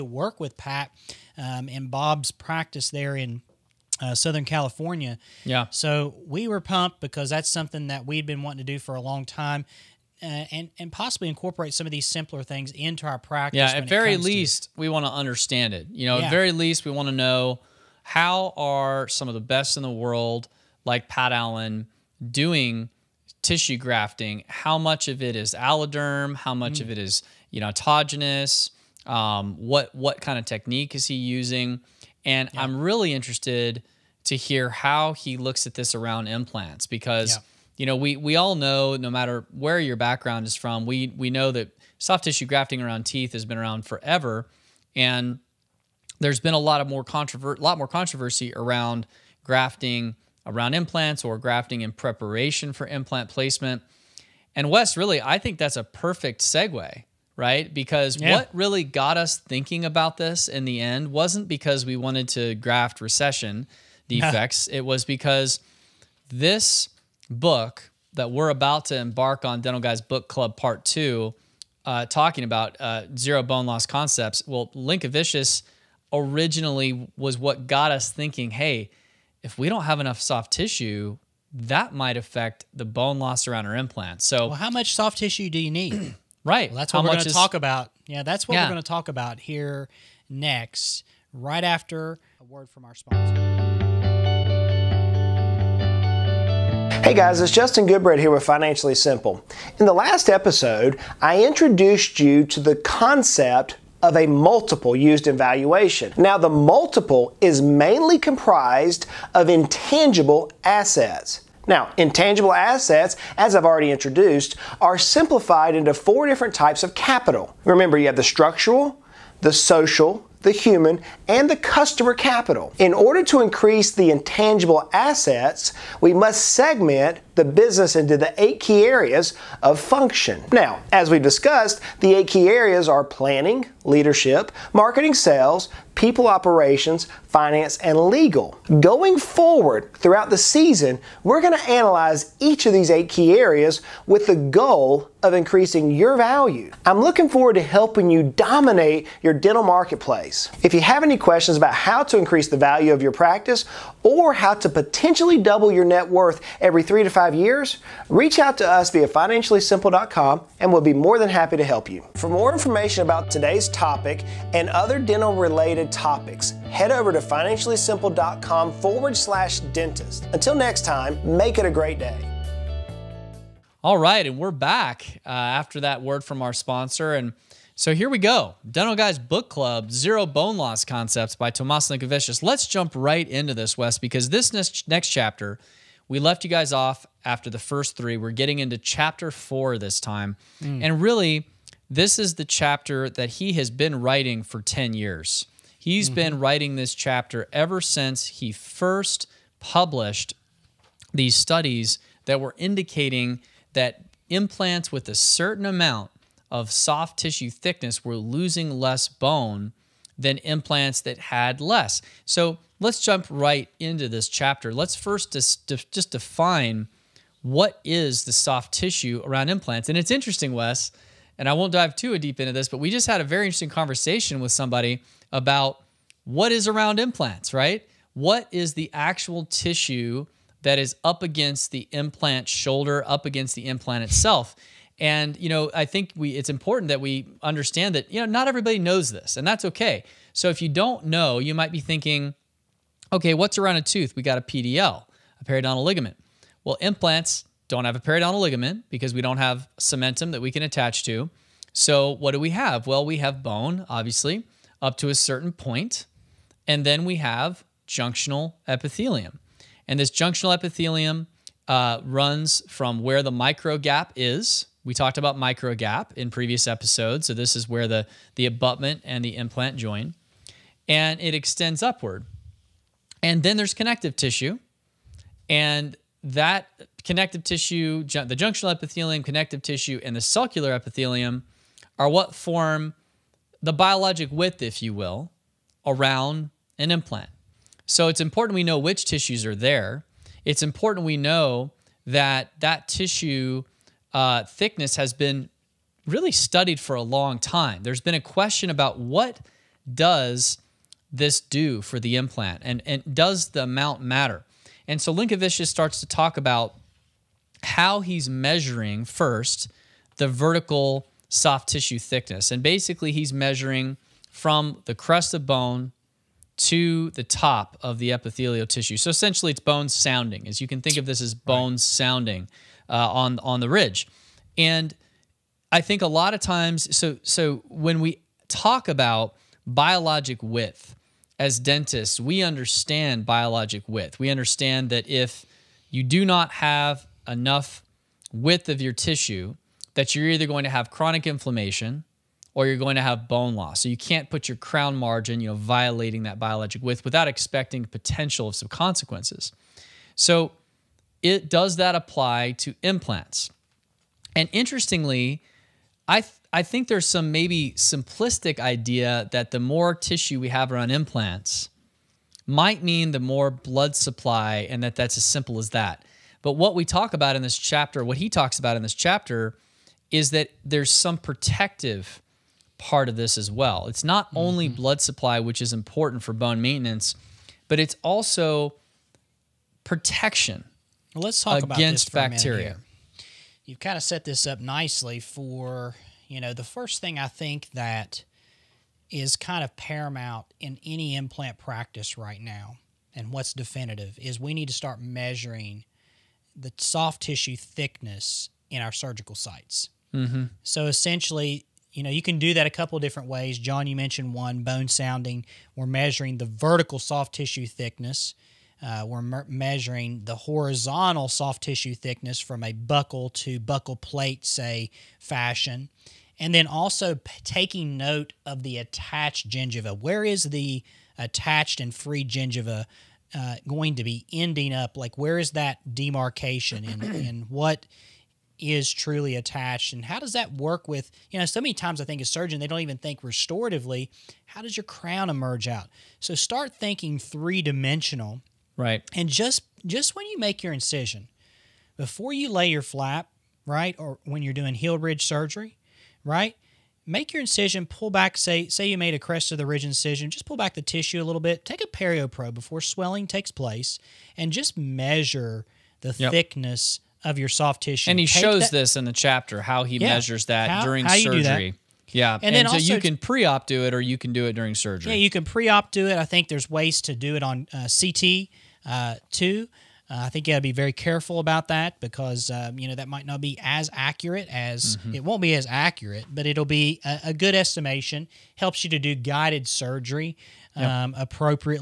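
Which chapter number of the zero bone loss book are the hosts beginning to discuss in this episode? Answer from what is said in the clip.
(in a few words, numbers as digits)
4.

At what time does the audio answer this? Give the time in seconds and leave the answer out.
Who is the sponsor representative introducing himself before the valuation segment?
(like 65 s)
97 s.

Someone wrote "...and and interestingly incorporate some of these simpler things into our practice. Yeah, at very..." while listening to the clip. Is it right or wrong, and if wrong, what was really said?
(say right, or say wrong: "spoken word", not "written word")
wrong: "possibly", not "interestingly".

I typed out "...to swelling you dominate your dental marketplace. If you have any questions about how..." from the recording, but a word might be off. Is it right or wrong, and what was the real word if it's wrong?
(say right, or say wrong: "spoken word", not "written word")
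wrong: "helping", not "swelling".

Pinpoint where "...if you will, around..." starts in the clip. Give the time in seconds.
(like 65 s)
284 s.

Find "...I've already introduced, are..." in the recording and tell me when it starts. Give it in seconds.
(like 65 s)
113 s.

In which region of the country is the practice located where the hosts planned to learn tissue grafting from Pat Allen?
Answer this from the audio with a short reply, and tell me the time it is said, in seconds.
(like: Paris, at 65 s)
Southern California, at 4 s.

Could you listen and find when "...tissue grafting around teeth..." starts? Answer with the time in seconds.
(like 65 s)
42 s.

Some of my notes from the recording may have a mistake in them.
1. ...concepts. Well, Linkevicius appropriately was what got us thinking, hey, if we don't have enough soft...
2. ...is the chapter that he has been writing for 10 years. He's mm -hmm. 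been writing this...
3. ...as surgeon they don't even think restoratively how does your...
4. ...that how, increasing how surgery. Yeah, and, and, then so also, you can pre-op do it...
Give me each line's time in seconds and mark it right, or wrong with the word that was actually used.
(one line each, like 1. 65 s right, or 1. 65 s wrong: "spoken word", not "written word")
1. 73 s wrong: "originally", not "appropriately"
2. 192 s right
3. 432 s right
4. 460 s wrong: "during", not "increasing".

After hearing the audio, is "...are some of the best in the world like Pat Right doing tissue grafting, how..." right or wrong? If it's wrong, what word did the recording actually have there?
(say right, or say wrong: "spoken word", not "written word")
wrong: "Allen", not "Right".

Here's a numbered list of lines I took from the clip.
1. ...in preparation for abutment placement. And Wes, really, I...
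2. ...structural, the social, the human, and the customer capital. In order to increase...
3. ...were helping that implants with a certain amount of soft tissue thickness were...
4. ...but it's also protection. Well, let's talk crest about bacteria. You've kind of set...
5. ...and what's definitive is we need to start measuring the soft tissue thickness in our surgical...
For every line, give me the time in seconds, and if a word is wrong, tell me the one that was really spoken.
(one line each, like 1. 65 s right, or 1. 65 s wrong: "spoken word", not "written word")
1. 51 s wrong: "implant", not "abutment"
2. 118 s right
3. 202 s wrong: "indicating", not "helping"
4. 377 s wrong: "against", not "crest"
5. 393 s right.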